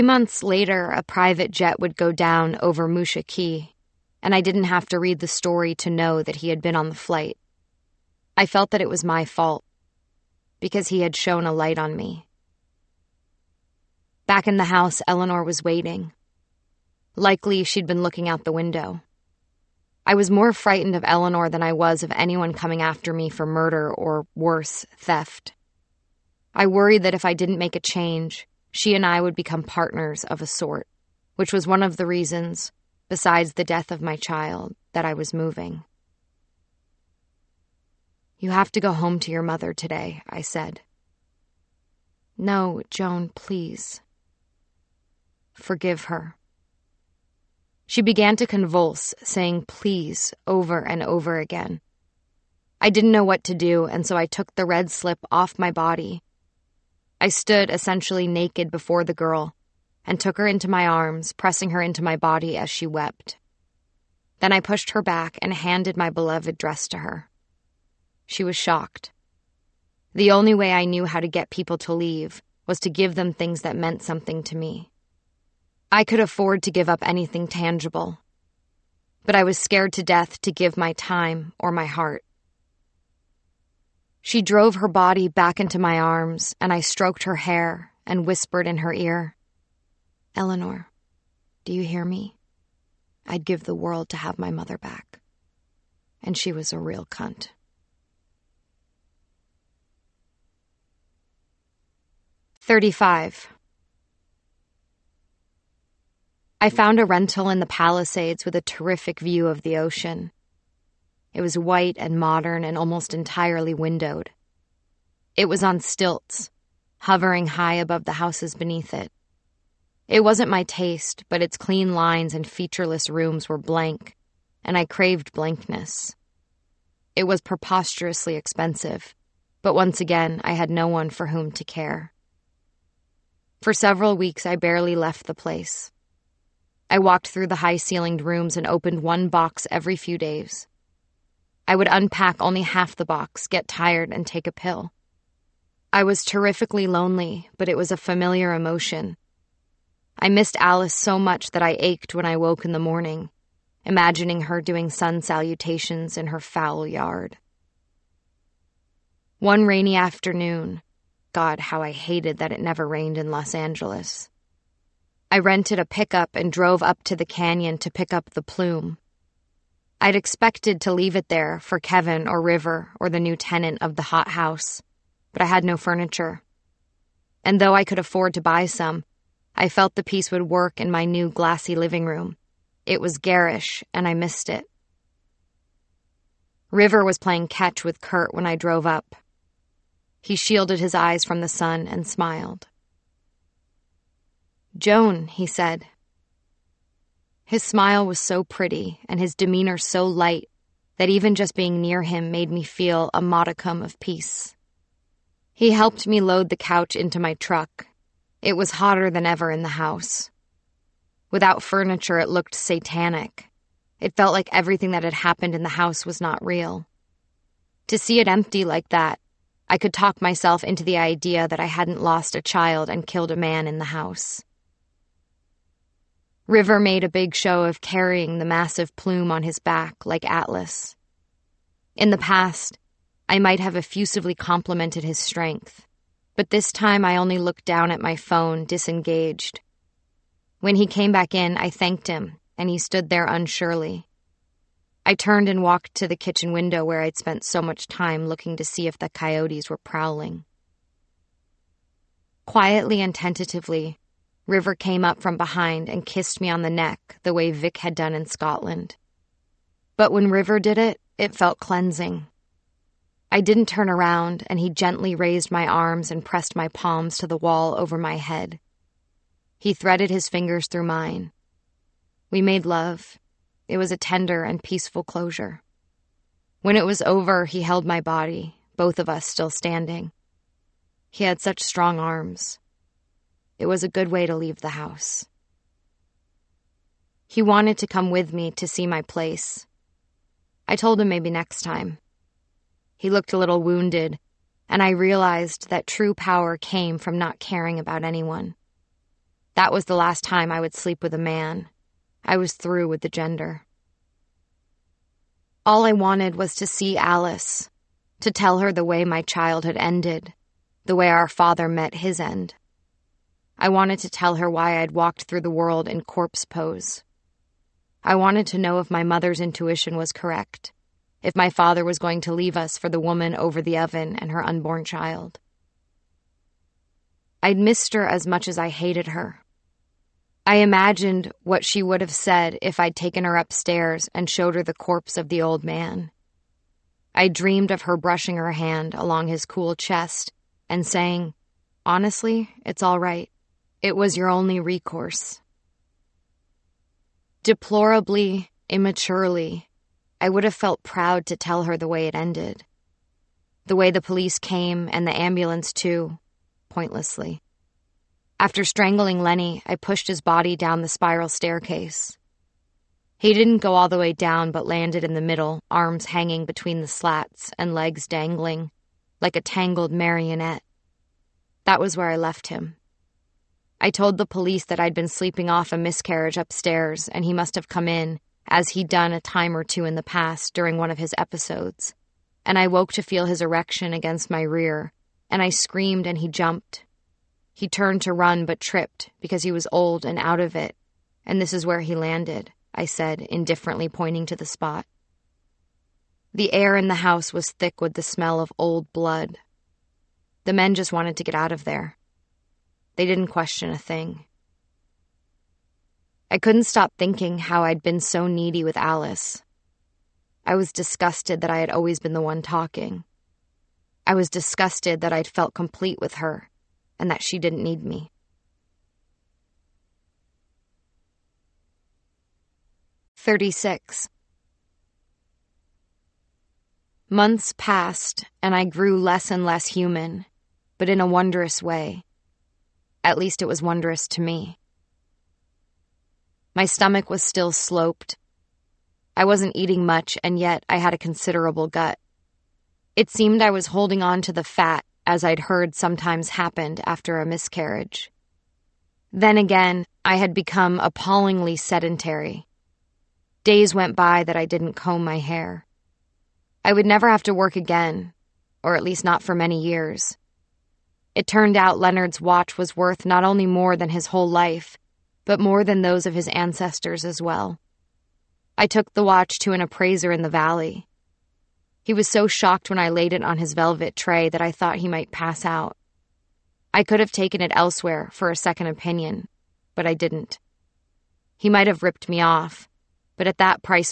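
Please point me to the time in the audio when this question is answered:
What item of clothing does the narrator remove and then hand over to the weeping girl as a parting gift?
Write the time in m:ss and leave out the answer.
0:54.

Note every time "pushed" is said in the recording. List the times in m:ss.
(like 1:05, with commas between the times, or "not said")
1:04, 5:59.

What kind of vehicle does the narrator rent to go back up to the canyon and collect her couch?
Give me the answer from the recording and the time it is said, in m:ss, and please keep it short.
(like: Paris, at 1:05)
pickup, at 2:45.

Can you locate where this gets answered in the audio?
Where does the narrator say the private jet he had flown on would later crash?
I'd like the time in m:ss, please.
0:02.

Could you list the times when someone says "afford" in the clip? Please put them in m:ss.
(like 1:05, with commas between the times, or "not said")
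1:16, 2:57.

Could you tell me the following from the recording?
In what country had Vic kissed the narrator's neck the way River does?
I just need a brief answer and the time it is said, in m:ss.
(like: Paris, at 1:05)
Scotland, at 4:18.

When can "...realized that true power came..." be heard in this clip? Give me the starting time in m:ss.
4:54.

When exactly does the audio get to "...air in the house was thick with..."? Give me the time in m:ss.
6:36.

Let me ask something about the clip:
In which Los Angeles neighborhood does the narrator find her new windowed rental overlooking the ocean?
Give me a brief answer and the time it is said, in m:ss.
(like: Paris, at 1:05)
the Palisades, at 1:47.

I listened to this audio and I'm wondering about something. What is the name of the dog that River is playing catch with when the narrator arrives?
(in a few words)
Kurt.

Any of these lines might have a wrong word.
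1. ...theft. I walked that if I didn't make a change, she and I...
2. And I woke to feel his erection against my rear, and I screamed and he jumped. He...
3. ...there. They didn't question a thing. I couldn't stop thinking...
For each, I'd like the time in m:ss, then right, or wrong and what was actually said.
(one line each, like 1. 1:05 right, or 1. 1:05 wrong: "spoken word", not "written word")
1. 0:24 wrong: "worried", not "walked"
2. 6:22 right
3. 6:41 right.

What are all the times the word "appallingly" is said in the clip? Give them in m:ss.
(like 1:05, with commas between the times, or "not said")
7:30.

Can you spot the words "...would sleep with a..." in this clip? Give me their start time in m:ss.
5:00.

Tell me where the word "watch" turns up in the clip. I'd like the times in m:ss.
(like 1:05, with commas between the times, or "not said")
7:42, 7:49.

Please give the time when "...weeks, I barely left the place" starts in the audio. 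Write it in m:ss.
2:14.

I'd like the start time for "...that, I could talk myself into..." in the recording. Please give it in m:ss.
3:38.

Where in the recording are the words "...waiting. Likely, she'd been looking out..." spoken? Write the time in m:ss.
0:15.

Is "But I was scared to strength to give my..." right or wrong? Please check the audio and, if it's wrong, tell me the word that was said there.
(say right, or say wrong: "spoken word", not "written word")
wrong: "death", not "strength".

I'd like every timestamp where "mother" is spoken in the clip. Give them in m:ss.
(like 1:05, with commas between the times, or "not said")
0:39, 1:34, 5:19.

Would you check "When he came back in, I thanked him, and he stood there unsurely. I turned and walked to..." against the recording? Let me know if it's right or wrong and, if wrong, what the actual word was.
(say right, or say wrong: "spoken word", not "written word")
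right.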